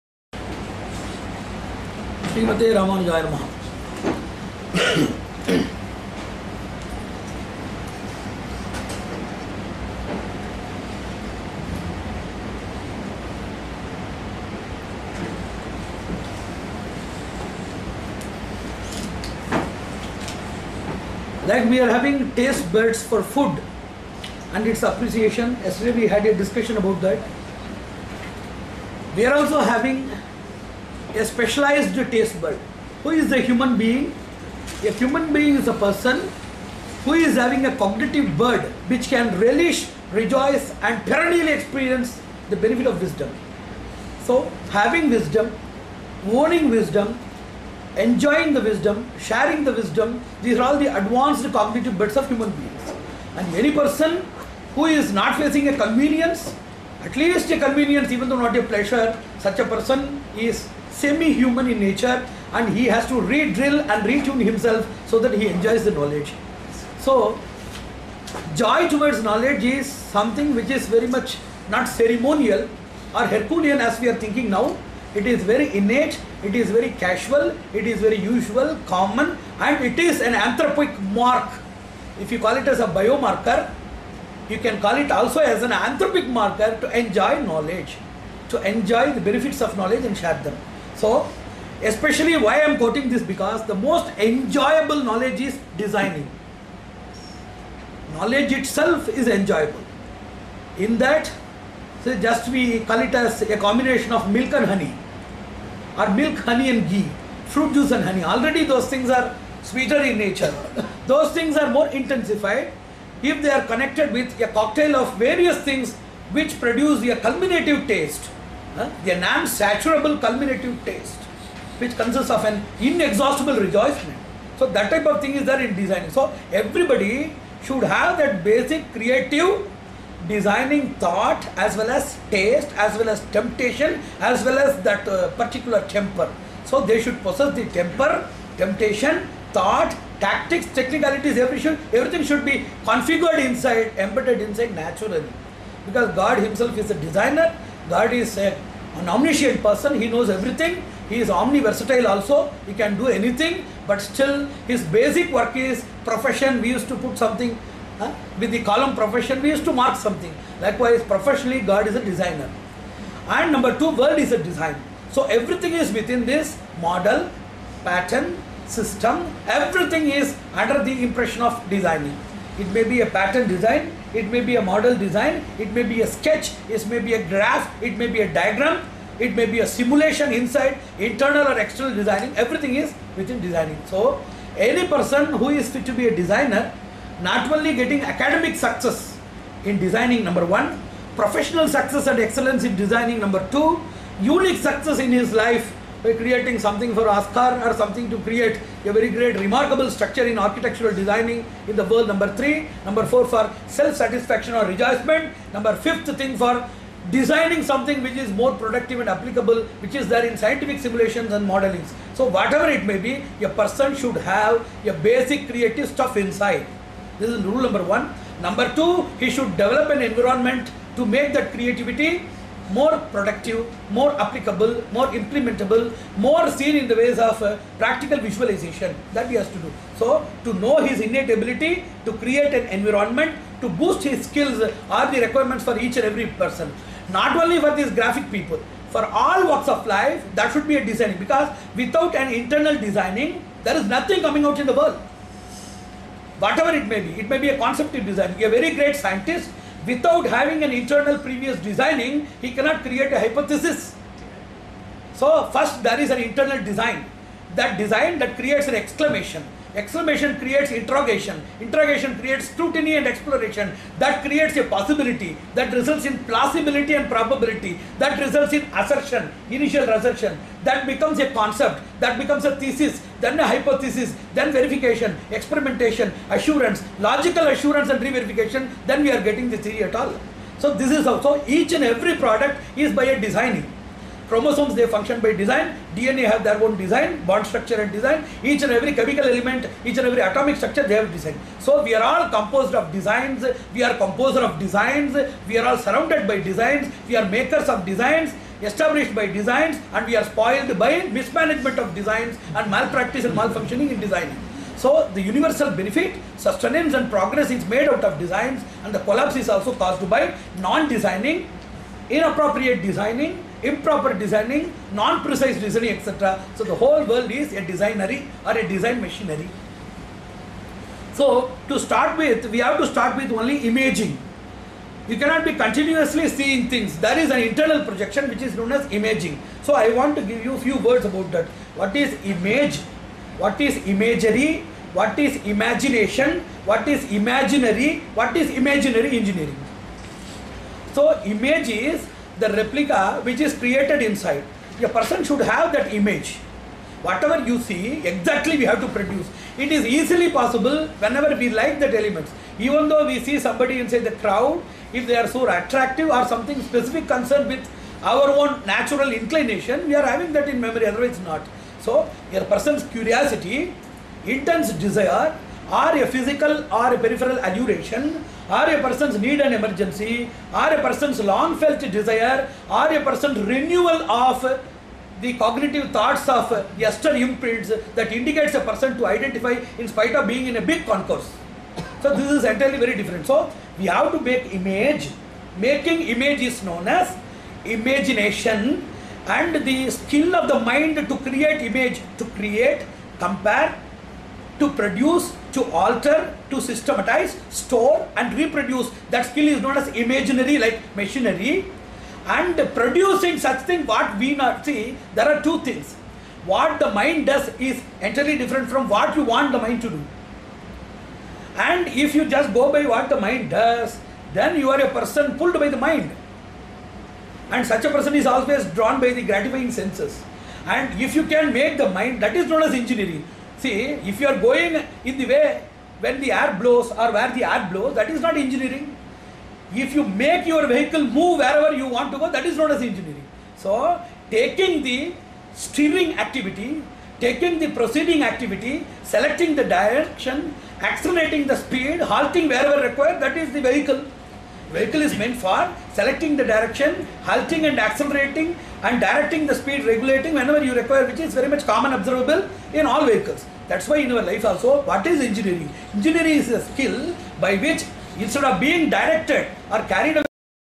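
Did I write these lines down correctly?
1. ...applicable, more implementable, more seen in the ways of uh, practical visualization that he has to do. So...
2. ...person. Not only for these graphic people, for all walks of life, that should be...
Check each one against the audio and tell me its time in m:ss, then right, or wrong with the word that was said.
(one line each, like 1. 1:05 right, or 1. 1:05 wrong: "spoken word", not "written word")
1. 3:44 right
2. 3:56 right.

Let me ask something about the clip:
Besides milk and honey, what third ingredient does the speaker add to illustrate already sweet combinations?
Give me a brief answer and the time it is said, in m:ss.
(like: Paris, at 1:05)
ghee, at 1:46.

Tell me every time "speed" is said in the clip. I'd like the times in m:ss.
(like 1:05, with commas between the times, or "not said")
7:21, 7:29.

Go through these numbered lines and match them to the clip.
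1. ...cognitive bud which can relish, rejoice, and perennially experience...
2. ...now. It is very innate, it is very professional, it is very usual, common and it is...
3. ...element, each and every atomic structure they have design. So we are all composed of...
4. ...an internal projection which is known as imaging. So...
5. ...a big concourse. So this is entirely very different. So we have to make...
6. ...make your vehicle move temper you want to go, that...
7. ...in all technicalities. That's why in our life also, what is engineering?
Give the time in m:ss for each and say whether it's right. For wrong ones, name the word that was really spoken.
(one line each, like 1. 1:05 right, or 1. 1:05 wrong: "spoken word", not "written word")
1. 0:37 right
2. 1:14 wrong: "casual", not "professional"
3. 4:49 right
4. 5:27 right
5. 6:20 right
6. 7:10 wrong: "wherever", not "temper"
7. 7:32 wrong: "vehicles", not "technicalities".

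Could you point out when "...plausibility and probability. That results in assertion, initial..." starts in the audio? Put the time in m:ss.
4:26.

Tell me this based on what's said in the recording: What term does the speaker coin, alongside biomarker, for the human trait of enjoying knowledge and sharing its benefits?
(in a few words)
anthropic marker.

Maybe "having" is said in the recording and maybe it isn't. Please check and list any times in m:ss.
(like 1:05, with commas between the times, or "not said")
0:21, 0:29, 0:37, 0:44, 4:10, 6:00.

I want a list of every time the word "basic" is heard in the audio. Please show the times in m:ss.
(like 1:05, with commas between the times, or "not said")
2:08, 2:34, 3:34.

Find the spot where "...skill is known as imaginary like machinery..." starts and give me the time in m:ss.
6:39.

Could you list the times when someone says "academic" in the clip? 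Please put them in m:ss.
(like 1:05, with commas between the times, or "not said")
3:08.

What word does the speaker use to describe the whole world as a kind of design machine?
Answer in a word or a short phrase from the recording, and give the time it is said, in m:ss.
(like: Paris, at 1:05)
designery, at 5:17.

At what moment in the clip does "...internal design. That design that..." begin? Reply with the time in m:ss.
4:16.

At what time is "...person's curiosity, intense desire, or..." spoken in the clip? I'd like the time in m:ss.
6:02.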